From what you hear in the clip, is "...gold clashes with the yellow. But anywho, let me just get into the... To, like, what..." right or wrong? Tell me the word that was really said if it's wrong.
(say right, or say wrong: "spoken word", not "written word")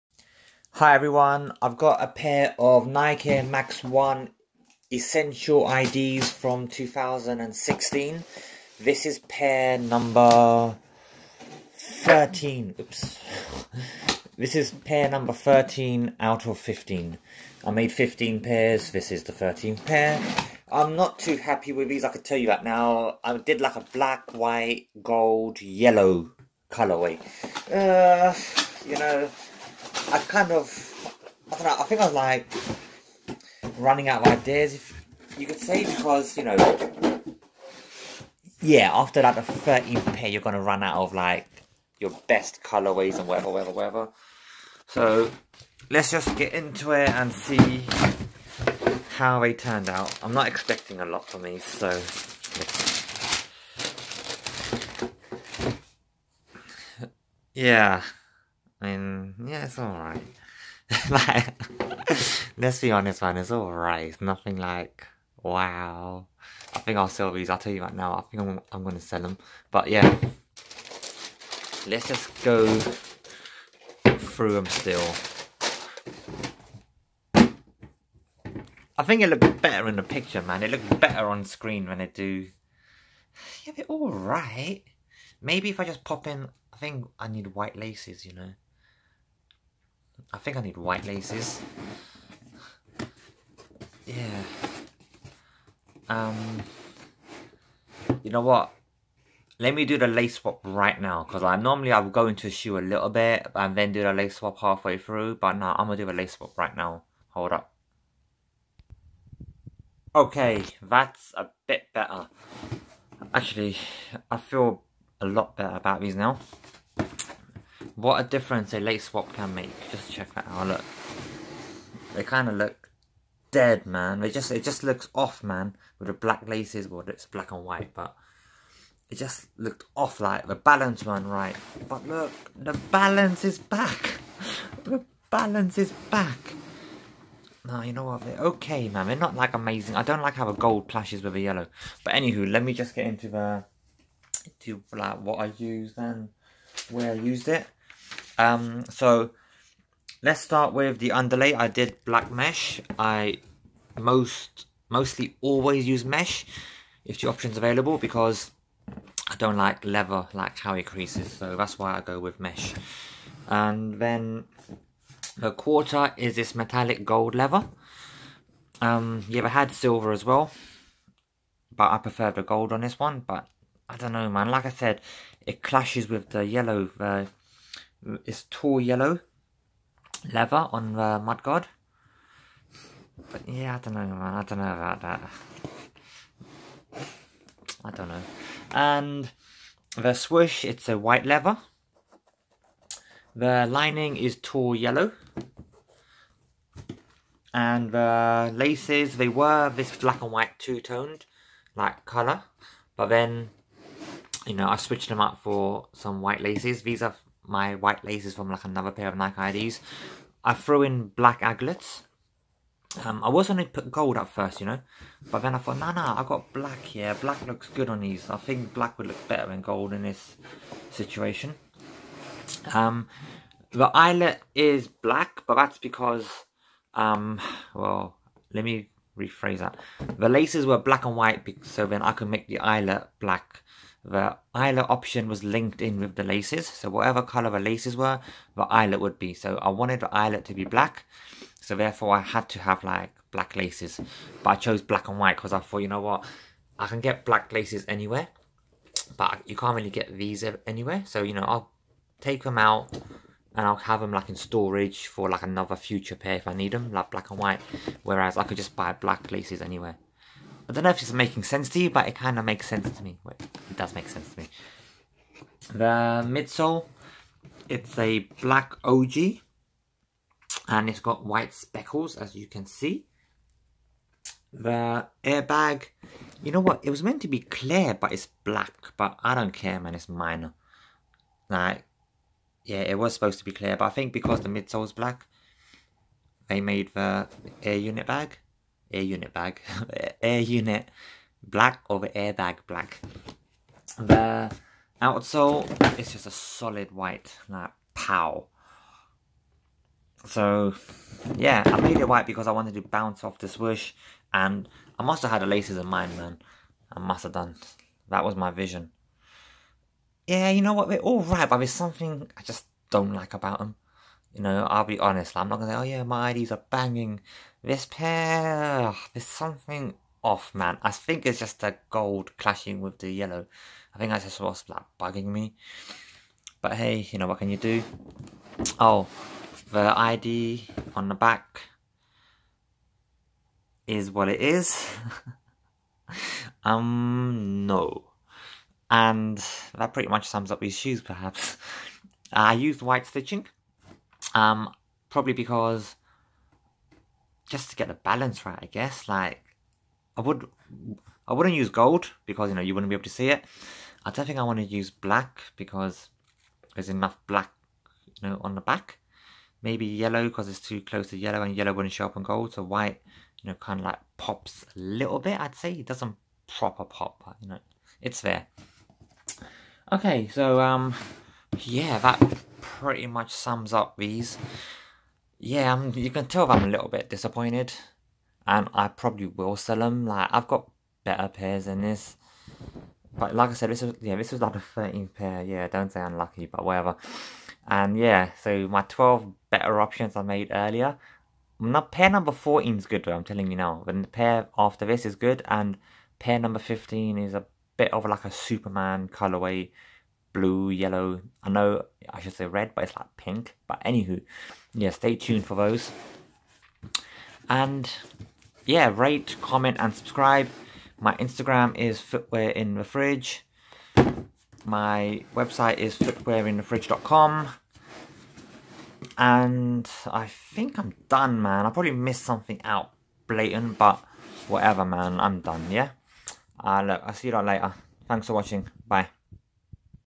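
right.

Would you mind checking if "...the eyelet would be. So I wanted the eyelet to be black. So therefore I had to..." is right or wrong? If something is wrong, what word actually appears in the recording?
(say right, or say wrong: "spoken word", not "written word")
right.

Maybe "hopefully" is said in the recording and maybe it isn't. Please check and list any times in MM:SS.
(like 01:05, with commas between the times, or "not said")
not said.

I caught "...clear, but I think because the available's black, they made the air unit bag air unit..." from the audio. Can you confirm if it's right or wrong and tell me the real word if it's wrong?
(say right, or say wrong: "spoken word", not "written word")
wrong: "midsole", not "available".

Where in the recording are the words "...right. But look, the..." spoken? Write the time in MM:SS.
02:11.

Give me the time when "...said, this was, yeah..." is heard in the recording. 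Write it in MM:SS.
06:23.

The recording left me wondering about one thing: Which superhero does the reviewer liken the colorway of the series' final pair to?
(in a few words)
Superman.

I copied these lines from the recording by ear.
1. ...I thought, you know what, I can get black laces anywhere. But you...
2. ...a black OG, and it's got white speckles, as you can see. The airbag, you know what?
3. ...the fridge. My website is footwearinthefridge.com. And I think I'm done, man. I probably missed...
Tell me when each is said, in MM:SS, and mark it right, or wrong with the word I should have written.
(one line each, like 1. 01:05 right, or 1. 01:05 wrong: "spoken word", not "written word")
1. 04:05 right
2. 04:27 right
3. 06:52 right.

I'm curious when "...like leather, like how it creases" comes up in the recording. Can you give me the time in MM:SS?
02:39.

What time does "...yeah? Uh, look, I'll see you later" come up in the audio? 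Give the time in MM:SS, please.
07:05.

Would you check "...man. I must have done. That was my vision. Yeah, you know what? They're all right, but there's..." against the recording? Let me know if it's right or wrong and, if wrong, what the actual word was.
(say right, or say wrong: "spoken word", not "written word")
right.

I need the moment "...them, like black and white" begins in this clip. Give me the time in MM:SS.
04:16.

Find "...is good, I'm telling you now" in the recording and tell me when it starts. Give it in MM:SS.
06:32.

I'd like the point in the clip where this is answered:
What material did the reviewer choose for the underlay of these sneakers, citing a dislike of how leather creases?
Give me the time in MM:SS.
02:32.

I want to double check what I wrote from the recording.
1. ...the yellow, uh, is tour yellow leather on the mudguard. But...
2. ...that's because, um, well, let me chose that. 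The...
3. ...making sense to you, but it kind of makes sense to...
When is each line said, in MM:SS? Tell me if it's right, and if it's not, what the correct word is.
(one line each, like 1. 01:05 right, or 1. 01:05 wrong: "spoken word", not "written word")
1. 02:56 right
2. 03:45 wrong: "rephrase", not "chose"
3. 04:21 right.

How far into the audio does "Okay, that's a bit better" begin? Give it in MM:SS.
01:50.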